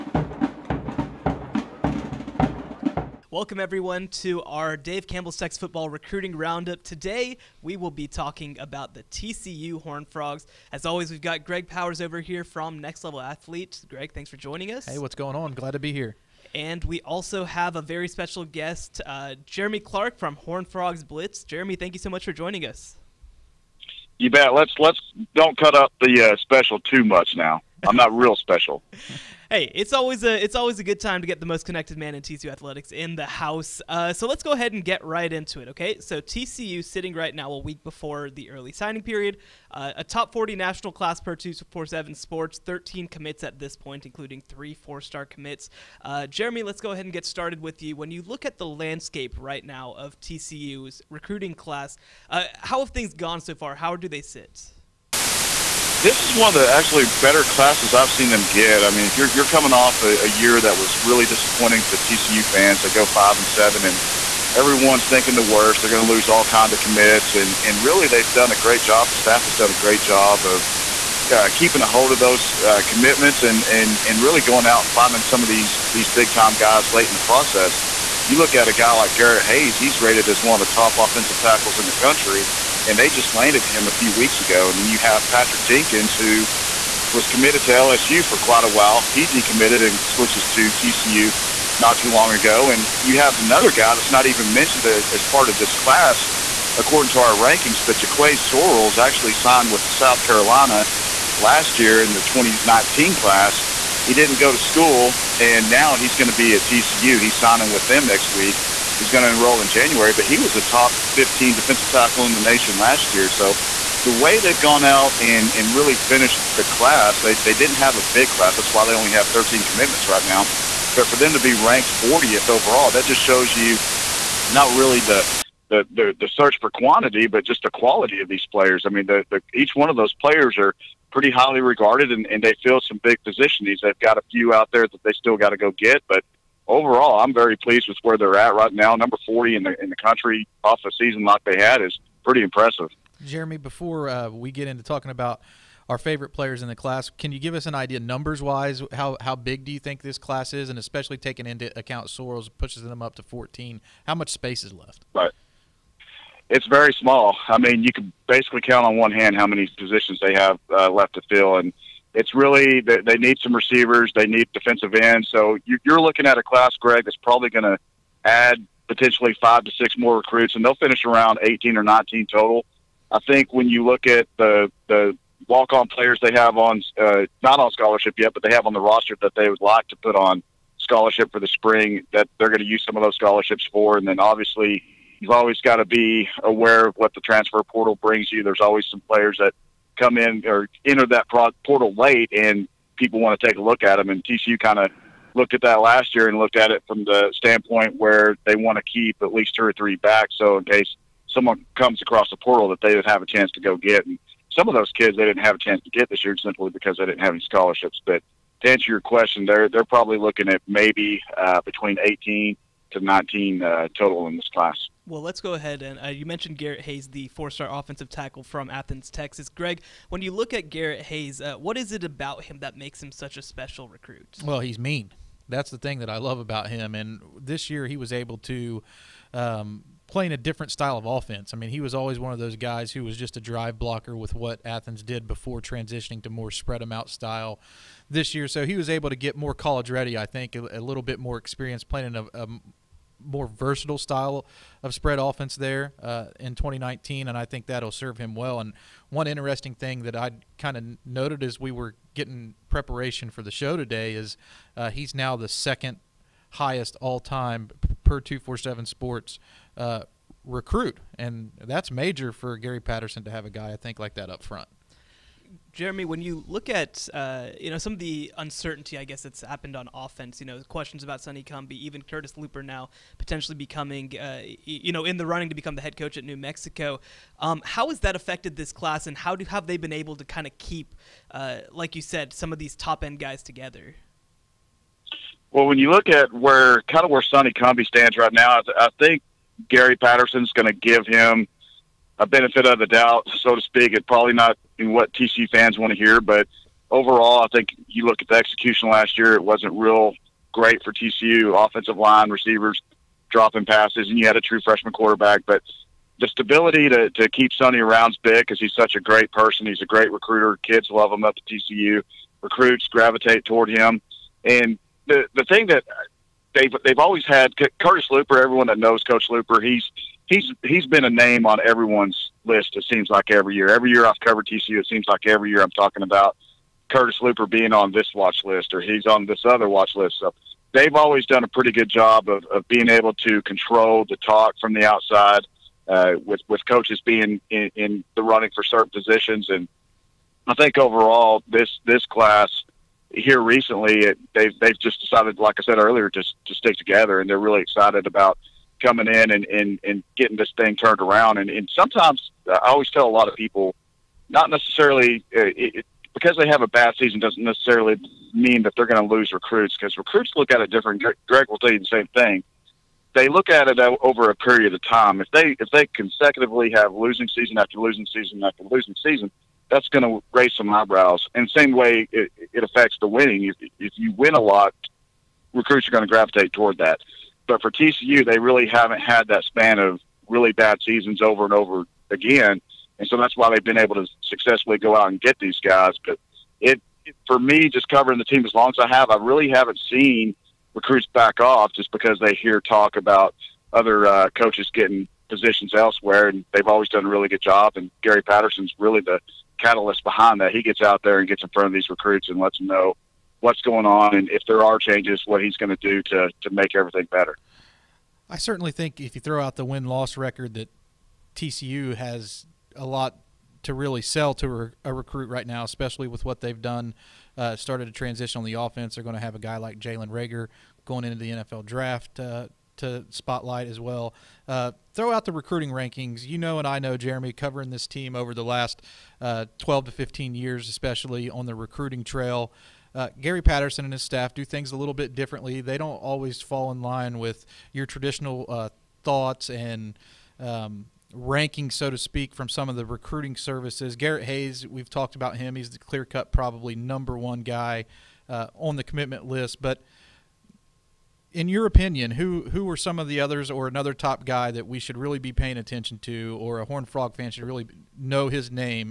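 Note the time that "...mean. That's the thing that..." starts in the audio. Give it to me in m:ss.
3:44.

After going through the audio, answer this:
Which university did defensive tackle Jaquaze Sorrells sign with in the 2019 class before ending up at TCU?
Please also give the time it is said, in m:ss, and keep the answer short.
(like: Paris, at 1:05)
South Carolina, at 1:39.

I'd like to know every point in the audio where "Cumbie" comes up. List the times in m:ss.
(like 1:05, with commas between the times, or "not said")
4:31, 4:47.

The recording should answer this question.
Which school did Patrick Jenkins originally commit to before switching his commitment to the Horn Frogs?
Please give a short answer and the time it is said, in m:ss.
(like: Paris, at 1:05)
LSU, at 1:27.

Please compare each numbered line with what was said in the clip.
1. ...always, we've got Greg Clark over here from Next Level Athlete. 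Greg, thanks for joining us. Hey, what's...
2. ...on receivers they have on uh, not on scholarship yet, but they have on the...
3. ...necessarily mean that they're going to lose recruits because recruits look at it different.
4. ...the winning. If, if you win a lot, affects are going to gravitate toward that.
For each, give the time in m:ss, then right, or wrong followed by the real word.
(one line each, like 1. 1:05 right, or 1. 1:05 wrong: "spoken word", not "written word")
1. 0:10 wrong: "Powers", not "Clark"
2. 2:55 wrong: "players", not "receivers"
3. 5:57 right
4. 6:12 wrong: "recruits", not "affects".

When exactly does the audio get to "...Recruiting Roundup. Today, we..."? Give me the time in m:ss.
0:05.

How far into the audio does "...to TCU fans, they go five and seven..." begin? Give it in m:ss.
1:01.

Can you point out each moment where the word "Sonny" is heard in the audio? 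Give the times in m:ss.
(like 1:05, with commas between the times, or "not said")
4:31, 4:47, 5:07.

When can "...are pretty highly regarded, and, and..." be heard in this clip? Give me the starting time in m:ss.
2:10.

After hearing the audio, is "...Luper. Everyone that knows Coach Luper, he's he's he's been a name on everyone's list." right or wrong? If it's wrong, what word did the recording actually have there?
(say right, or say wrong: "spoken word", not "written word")
right.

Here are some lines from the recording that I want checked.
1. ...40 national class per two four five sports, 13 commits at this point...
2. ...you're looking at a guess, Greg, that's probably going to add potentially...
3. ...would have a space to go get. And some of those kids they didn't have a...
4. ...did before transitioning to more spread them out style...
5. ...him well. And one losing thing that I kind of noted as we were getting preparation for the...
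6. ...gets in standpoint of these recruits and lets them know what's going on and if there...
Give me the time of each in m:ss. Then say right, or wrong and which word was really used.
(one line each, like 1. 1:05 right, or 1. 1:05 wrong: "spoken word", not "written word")
1. 0:40 wrong: "seven", not "five"
2. 2:45 wrong: "class", not "guess"
3. 3:22 wrong: "chance", not "space"
4. 3:55 right
5. 4:08 wrong: "interesting", not "losing"
6. 6:41 wrong: "front", not "standpoint".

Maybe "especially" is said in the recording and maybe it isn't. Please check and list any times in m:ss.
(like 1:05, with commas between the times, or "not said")
2:30, 6:55, 7:10.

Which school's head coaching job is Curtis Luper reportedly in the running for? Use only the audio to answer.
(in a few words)
New Mexico.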